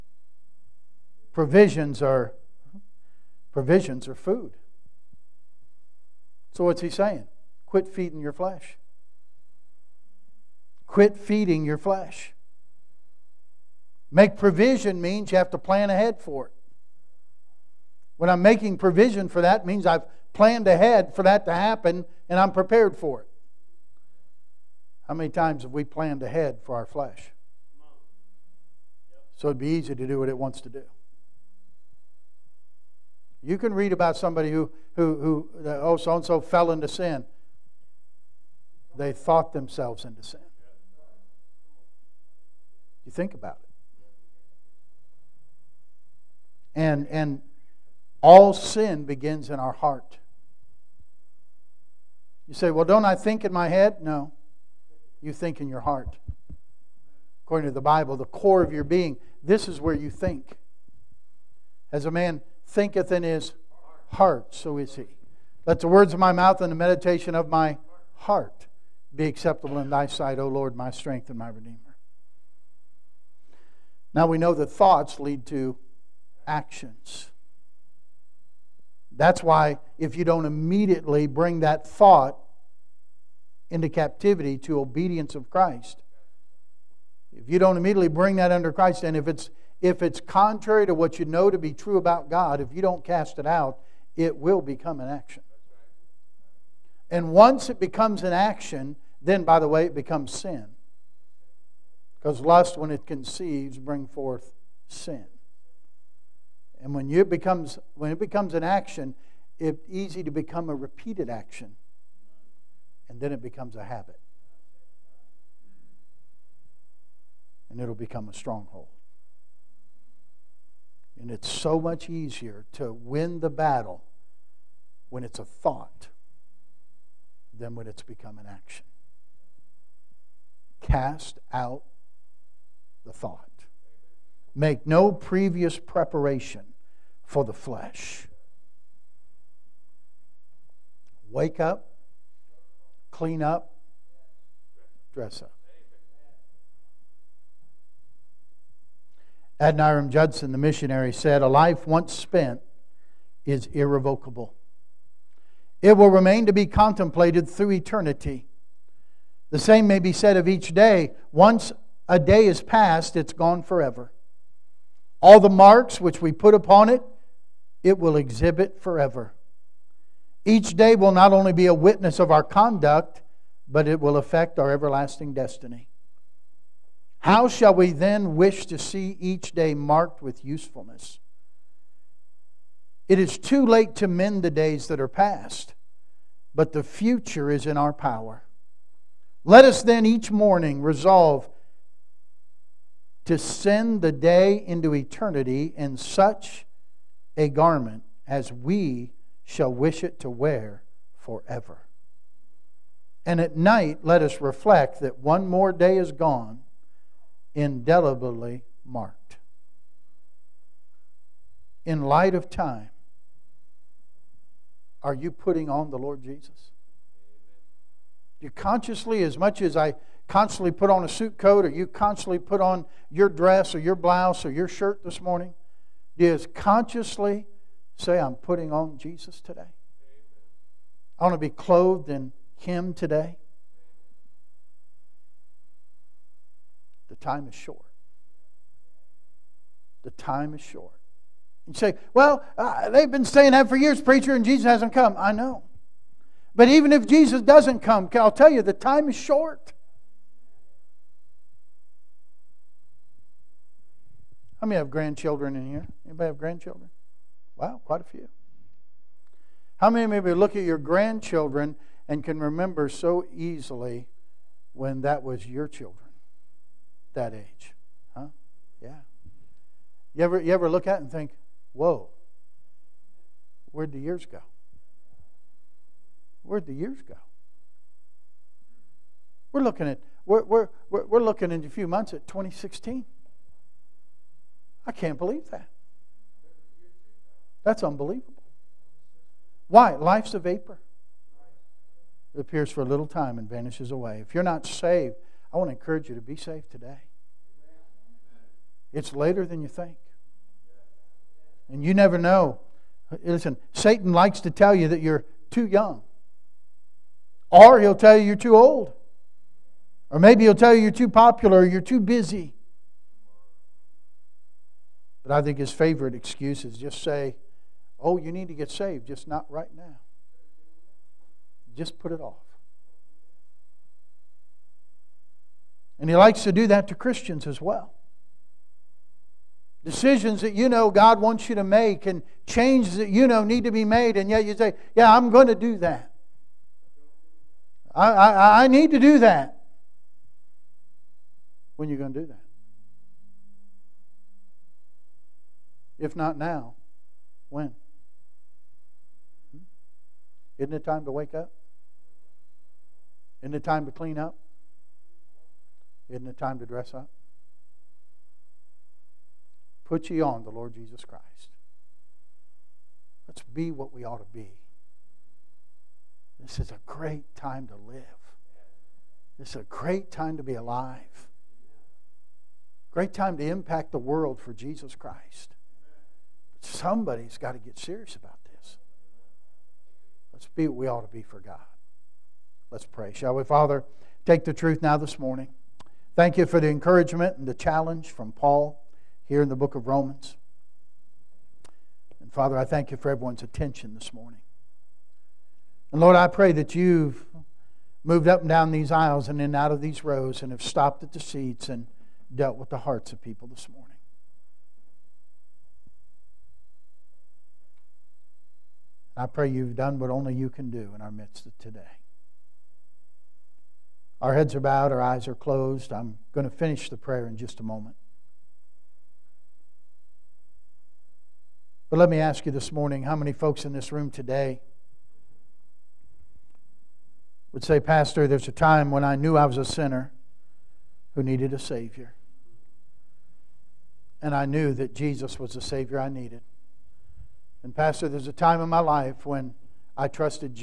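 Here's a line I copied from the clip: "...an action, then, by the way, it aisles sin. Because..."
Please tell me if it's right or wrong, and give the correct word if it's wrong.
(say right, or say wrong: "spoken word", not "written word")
wrong: "becomes", not "aisles".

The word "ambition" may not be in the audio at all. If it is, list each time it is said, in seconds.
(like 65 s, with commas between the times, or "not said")
not said.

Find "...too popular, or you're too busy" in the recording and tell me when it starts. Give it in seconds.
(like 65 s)
310 s.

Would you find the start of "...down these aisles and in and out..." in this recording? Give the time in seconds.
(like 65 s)
398 s.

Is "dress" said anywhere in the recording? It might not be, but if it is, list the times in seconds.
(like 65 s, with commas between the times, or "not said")
145 s, 223 s, 356 s.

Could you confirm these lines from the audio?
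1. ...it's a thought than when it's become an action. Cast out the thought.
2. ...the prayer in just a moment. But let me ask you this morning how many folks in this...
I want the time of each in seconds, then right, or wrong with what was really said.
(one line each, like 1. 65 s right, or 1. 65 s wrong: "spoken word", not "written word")
1. 125 s right
2. 416 s right.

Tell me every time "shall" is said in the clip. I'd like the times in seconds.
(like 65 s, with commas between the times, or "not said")
177 s, 199 s, 383 s.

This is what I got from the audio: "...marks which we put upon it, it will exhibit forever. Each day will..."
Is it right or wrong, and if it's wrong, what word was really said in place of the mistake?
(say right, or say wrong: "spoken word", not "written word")
right.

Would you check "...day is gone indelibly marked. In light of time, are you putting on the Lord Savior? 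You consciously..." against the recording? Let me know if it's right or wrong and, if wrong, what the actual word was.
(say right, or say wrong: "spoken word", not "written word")
wrong: "Jesus", not "Savior".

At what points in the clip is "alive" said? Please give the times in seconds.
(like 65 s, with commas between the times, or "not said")
370 s.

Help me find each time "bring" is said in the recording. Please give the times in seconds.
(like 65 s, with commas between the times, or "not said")
81 s, 88 s, 103 s.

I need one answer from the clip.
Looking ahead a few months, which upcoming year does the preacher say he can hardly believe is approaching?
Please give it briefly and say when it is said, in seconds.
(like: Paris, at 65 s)
2016, at 282 s.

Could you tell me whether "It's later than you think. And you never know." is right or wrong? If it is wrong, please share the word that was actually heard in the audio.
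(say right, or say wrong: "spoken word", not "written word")
right.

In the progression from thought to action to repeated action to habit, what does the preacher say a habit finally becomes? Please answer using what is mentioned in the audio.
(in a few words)
a stronghold.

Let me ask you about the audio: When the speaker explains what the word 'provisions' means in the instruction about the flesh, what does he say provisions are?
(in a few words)
food.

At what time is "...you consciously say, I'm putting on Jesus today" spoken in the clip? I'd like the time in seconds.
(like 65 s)
226 s.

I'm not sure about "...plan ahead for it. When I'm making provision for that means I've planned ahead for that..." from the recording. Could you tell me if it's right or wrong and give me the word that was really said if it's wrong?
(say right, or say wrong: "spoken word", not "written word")
right.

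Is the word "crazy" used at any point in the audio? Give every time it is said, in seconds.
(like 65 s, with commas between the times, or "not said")
not said.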